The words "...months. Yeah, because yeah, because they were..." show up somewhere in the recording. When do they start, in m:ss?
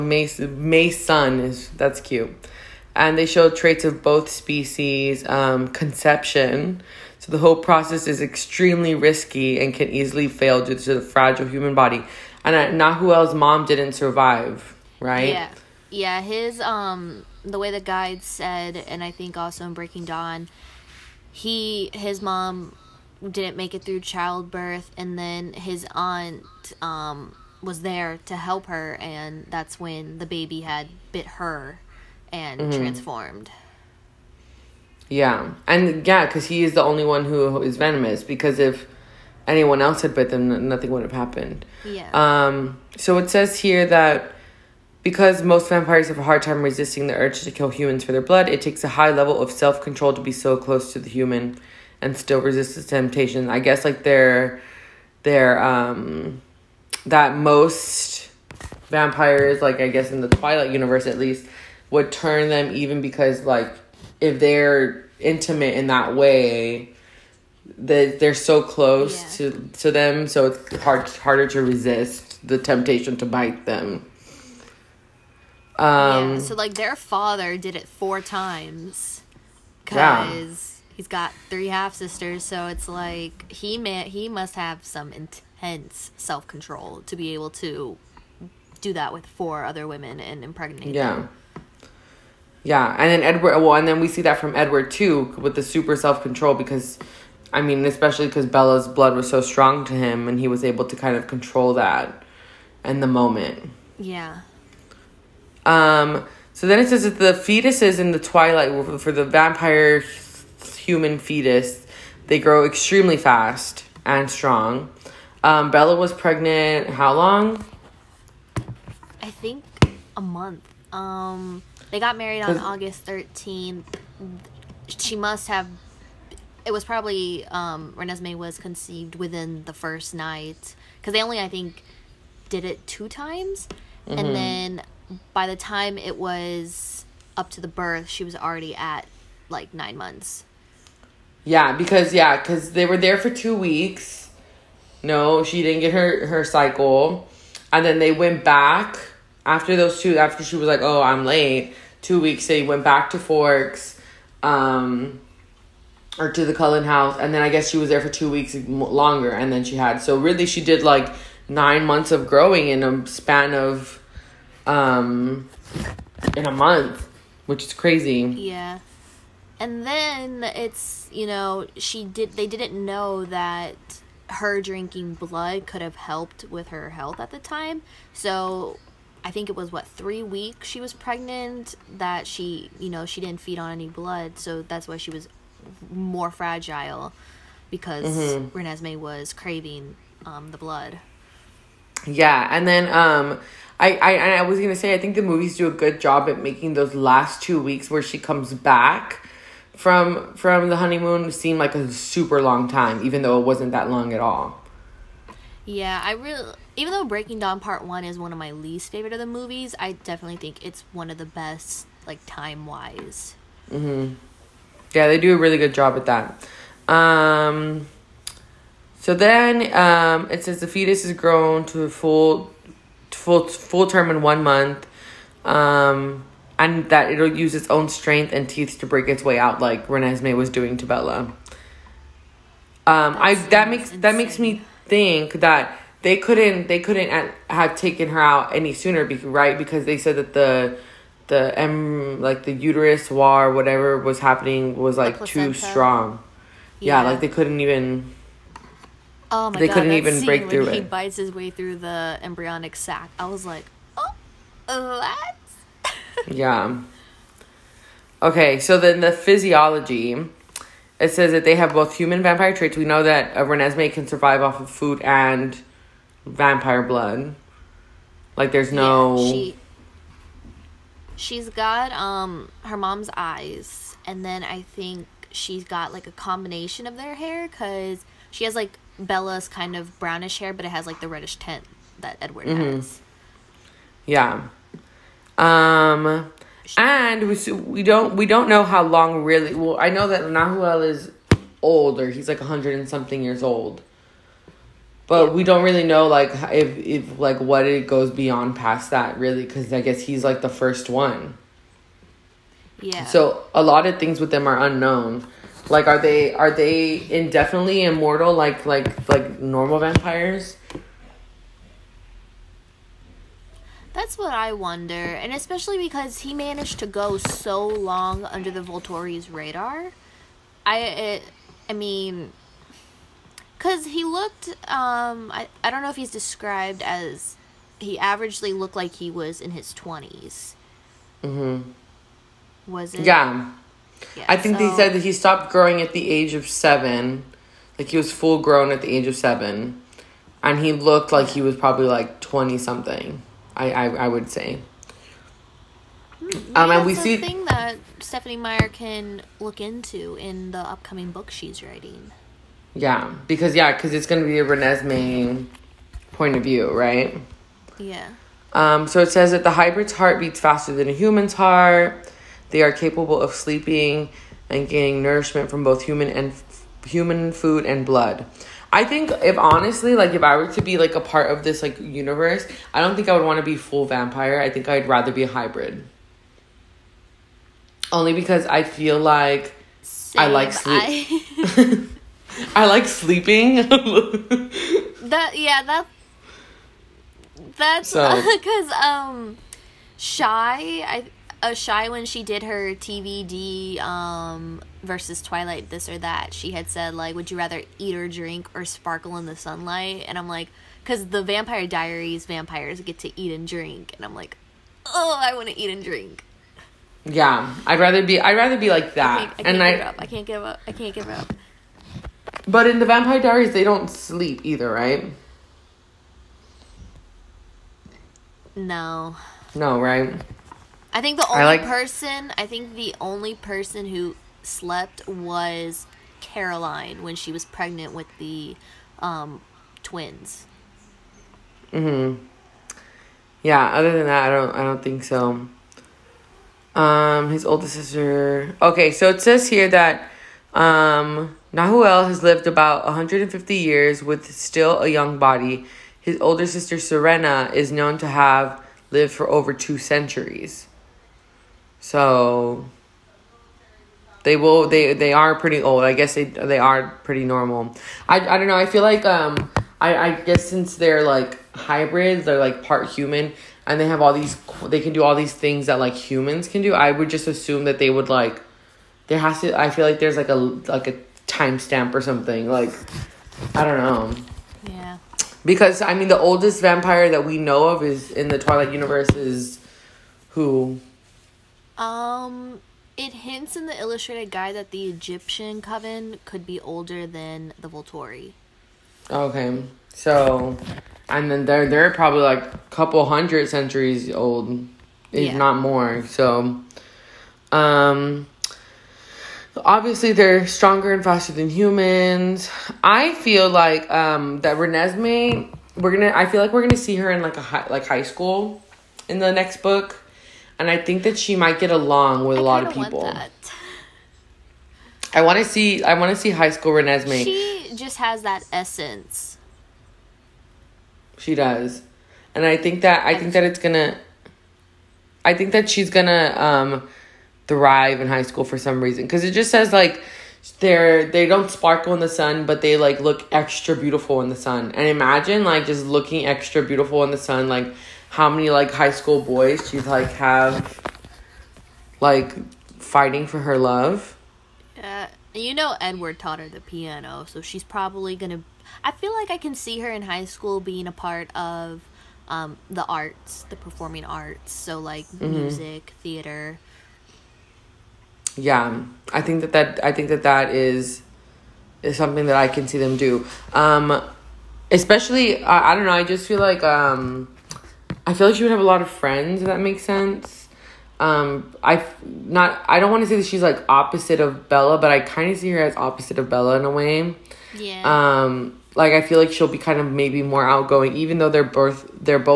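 2:19.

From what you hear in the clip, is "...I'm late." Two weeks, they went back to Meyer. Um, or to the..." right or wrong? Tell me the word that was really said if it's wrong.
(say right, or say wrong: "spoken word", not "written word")
wrong: "Forks", not "Meyer".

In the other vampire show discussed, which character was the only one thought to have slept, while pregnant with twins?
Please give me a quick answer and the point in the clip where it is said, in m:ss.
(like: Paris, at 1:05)
Caroline, at 7:06.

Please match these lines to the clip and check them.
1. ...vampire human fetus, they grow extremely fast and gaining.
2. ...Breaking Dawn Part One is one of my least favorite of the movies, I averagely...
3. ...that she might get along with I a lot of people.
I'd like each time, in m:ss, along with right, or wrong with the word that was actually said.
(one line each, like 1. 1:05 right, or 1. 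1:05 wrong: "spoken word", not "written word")
1. 1:49 wrong: "strong", not "gaining"
2. 3:27 wrong: "definitely", not "averagely"
3. 8:31 right.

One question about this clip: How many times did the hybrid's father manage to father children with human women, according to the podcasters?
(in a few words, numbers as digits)
4.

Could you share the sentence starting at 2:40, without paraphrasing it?
So really, she did like nine months of growing in a span of, um, in a month, which is crazy.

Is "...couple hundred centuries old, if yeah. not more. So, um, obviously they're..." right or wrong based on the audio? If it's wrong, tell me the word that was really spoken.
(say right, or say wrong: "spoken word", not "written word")
right.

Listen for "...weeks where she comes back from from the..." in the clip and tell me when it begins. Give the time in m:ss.
3:17.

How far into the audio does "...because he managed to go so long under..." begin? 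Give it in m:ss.
5:15.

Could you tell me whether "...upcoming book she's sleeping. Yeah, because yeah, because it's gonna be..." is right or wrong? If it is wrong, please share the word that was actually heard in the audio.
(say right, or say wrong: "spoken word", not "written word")
wrong: "writing", not "sleeping".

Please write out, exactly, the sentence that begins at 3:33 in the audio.
Mm-hmm yeah, they do a really good job at that.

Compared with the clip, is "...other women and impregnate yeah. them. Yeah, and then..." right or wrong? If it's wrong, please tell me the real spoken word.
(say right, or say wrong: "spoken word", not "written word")
right.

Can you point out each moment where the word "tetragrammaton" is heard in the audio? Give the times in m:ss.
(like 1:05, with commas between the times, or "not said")
not said.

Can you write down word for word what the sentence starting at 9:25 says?
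I just feel like um, I feel like she would have a lot of friends.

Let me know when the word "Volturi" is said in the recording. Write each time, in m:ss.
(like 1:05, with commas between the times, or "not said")
5:18, 8:07.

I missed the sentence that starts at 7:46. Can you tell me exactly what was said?
I would just assume that they would like there has to I feel like there's like a like a timestamp or something.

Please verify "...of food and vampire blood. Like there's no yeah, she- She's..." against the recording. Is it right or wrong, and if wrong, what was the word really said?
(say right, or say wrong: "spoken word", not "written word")
right.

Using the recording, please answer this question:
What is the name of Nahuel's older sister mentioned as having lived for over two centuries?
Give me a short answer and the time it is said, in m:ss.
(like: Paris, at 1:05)
Serena, at 7:26.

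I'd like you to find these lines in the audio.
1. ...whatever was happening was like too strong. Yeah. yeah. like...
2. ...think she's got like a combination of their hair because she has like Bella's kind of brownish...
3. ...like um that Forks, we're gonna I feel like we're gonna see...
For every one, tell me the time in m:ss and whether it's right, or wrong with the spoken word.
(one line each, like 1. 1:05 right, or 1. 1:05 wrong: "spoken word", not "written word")
1. 4:03 right
2. 4:34 right
3. 8:23 wrong: "Renesmee", not "Forks".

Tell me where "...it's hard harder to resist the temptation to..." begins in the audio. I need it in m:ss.
1:10.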